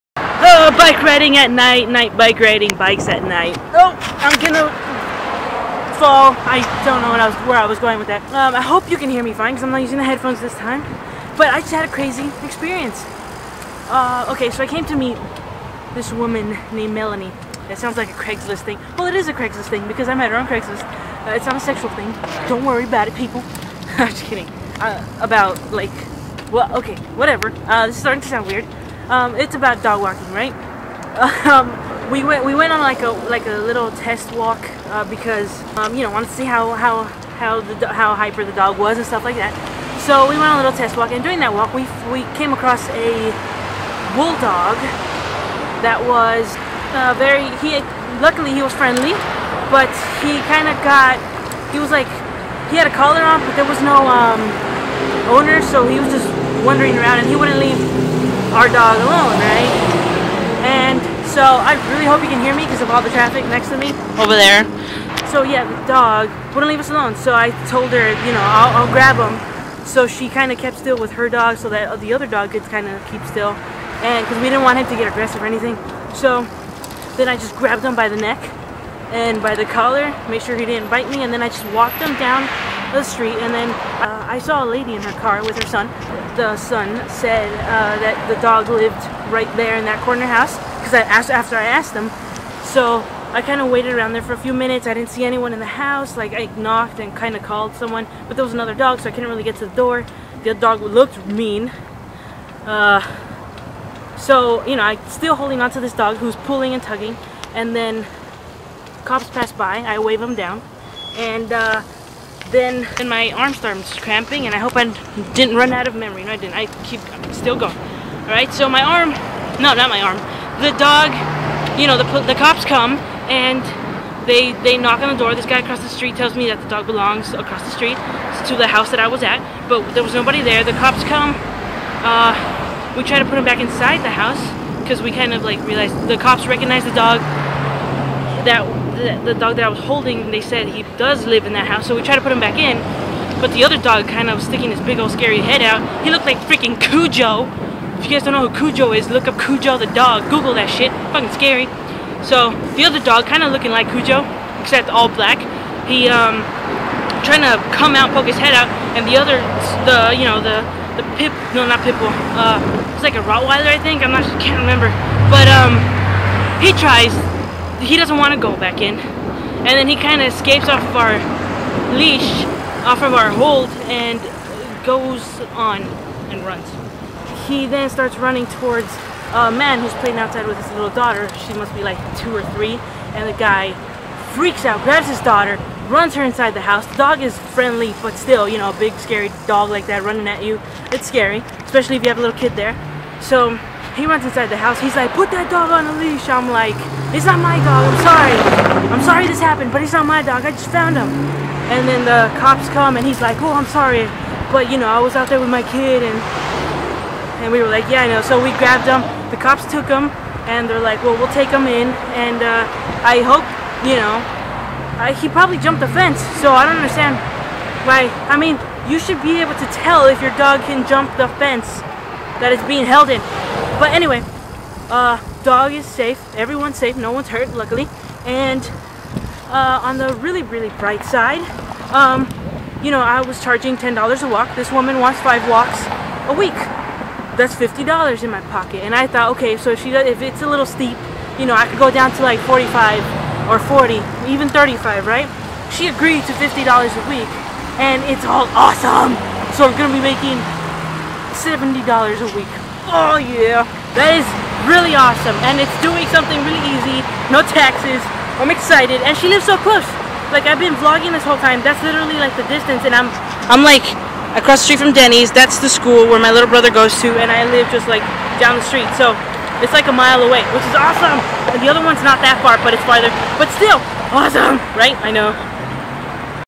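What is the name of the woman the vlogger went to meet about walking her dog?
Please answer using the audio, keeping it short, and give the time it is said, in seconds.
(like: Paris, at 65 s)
Melanie, at 16 s.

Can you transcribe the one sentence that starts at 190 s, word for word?
It's scary, especially if you have a little kid there.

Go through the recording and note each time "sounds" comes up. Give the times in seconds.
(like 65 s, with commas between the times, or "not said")
17 s, 28 s.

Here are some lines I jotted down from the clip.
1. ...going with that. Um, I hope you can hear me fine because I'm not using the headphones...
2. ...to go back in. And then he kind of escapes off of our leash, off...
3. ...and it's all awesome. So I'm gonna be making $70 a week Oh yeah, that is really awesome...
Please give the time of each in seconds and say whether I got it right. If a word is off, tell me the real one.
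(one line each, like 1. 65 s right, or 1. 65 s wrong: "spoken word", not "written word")
1. 7 s right
2. 168 s right
3. 247 s right.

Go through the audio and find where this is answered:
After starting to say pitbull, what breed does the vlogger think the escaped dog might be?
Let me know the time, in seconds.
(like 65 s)
163 s.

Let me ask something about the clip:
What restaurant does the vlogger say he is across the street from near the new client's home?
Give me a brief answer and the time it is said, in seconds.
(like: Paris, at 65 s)
Denny's, at 264 s.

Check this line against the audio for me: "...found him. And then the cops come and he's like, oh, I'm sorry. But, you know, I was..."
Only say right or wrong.
right.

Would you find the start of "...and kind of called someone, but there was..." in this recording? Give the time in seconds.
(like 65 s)
96 s.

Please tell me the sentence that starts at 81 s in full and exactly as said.
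And then I just walked him down the street, and then uh, I saw a lady in her car with her son.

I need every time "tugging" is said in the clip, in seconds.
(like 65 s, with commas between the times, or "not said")
106 s.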